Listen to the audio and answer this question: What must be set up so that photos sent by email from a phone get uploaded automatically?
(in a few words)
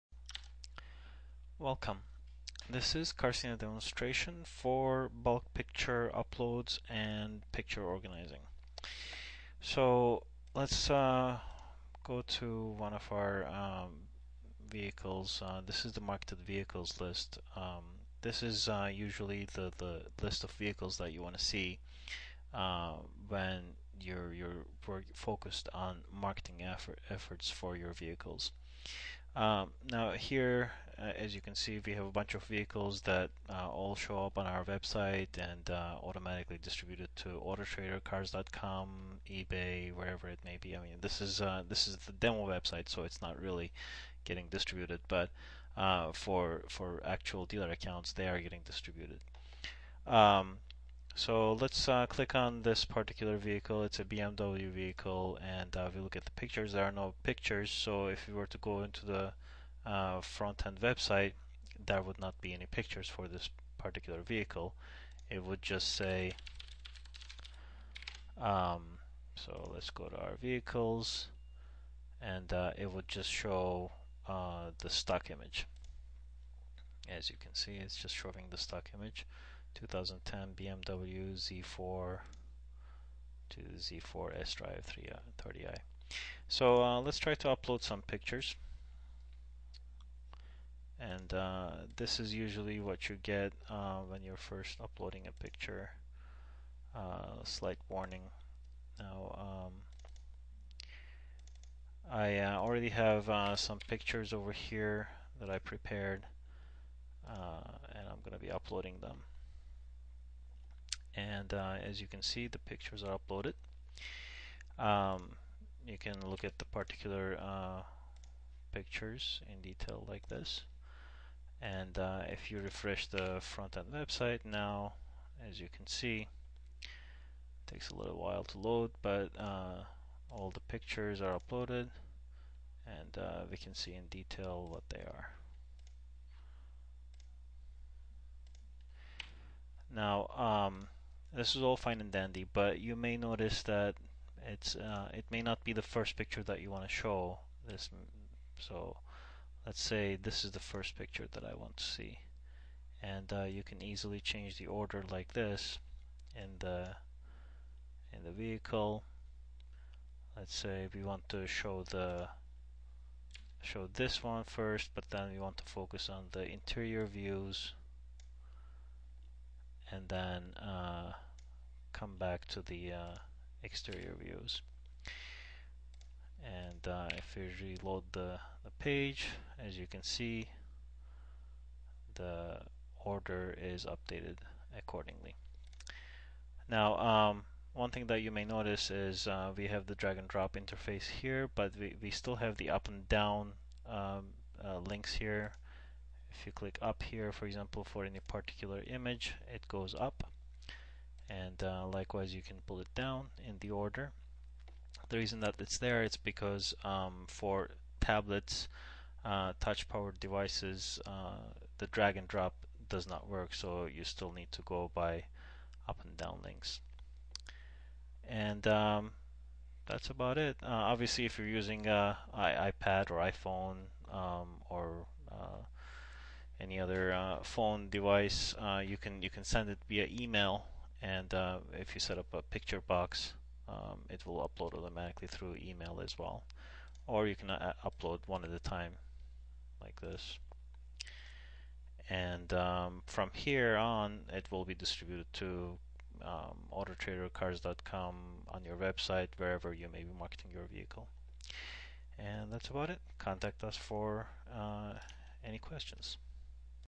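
A picture box.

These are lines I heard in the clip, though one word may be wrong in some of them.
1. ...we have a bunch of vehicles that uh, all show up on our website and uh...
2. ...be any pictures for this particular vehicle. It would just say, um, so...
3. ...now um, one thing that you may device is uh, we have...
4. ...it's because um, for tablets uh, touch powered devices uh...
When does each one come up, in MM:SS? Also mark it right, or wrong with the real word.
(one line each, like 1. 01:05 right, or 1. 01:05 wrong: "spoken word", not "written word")
1. 00:31 right
2. 01:02 right
3. 03:06 wrong: "notice", not "device"
4. 03:26 right.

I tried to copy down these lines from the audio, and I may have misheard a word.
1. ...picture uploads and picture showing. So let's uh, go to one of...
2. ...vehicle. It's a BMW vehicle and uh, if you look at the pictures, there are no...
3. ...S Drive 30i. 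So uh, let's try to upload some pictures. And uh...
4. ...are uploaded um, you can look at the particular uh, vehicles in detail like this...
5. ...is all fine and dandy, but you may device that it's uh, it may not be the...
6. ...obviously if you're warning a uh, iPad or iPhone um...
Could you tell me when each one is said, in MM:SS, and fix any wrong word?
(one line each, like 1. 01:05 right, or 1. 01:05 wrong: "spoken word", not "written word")
1. 00:05 wrong: "organizing", not "showing"
2. 00:53 right
3. 01:24 right
4. 01:53 wrong: "pictures", not "vehicles"
5. 02:21 wrong: "notice", not "device"
6. 03:40 wrong: "using", not "warning".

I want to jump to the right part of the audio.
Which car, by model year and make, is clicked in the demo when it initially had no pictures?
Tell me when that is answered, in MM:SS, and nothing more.
01:19.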